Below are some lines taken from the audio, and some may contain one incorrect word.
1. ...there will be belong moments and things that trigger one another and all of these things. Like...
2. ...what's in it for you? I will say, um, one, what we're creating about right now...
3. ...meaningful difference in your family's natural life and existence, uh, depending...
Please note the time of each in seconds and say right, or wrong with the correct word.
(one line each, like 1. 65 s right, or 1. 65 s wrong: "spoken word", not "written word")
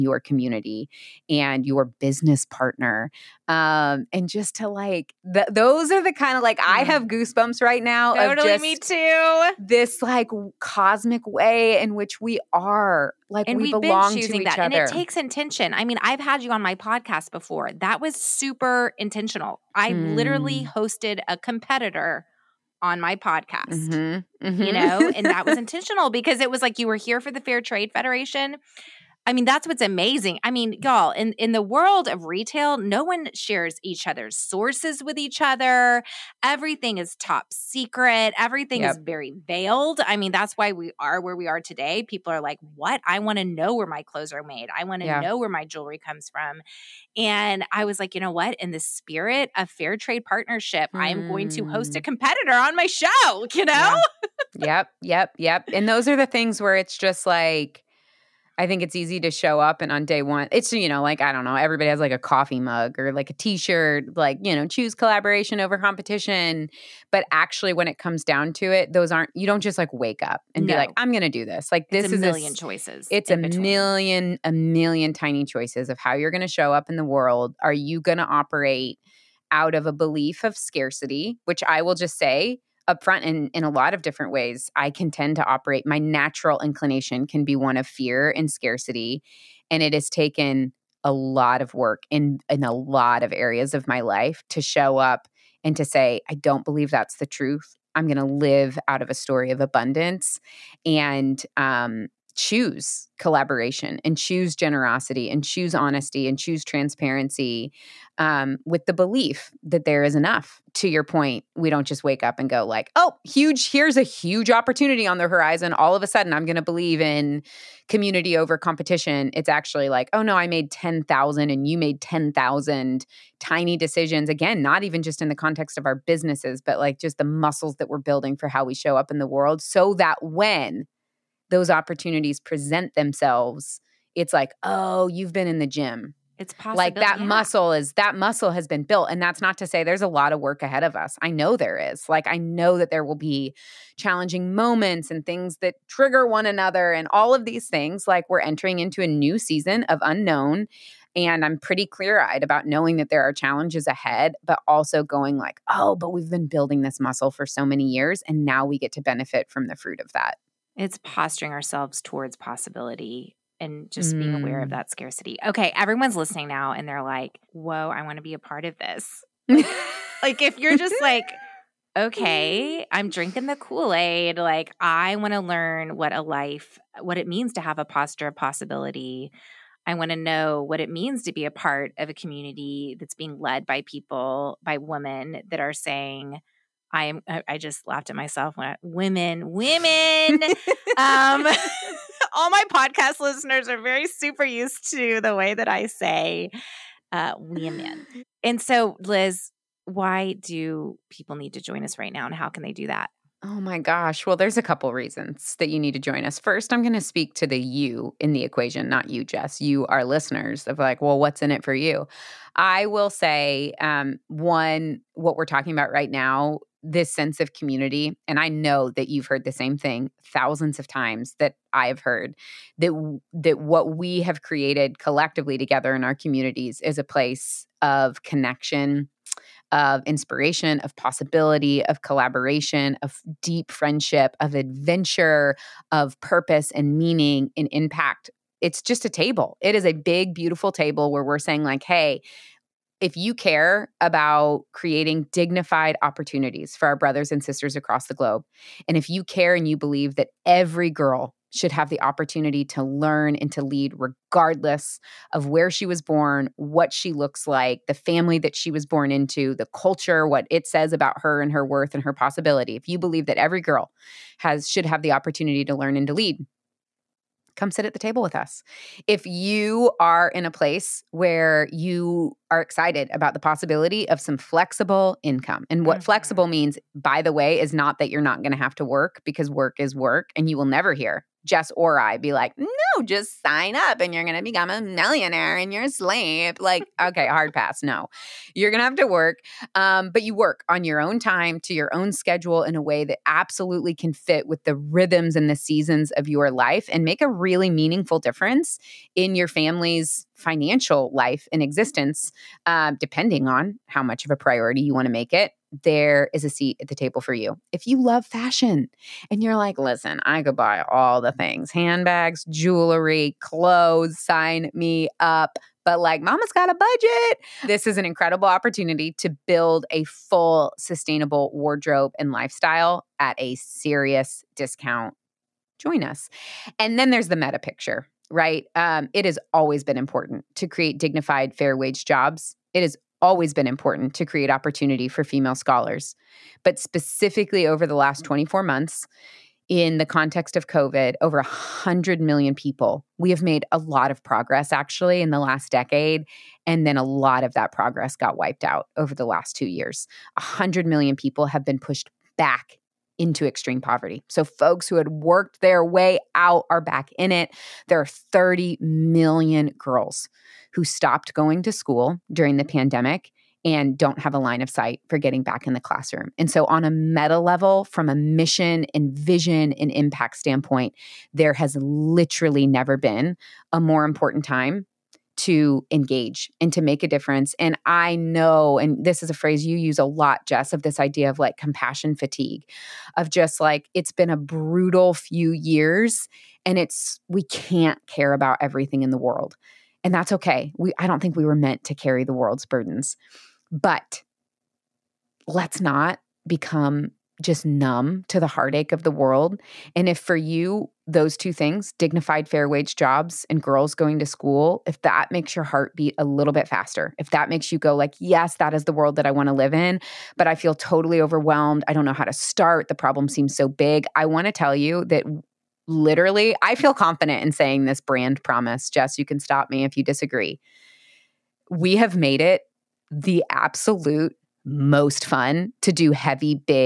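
1. 142 s wrong: "challenging", not "belong"
2. 211 s wrong: "talking", not "creating"
3. 297 s wrong: "financial", not "natural".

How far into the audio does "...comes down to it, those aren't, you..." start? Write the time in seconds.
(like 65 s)
67 s.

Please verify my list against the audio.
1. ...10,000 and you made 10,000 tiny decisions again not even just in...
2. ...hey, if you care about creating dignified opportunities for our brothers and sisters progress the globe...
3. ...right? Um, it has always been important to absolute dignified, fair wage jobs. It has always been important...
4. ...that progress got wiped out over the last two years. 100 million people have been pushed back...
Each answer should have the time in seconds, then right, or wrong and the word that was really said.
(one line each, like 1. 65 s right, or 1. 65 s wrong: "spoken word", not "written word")
1. 120 s right
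2. 241 s wrong: "across", not "progress"
3. 328 s wrong: "create", not "absolute"
4. 347 s right.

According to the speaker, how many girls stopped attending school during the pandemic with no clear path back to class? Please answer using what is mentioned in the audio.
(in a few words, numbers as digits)
30 million.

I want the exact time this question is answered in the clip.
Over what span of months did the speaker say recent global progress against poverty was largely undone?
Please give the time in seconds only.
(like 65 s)
338 s.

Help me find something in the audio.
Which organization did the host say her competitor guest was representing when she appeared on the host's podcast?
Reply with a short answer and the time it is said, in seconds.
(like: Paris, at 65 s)
Fair Trade Federation, at 27 s.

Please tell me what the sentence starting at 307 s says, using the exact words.
If you love fashion and you're like, listen, I could buy all the things handbags, jewelry, clothes, sign me up.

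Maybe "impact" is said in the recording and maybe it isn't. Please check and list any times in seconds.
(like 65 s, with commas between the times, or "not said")
237 s, 369 s.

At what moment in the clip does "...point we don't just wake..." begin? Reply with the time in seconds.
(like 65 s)
111 s.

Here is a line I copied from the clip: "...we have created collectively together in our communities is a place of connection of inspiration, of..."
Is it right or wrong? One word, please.
right.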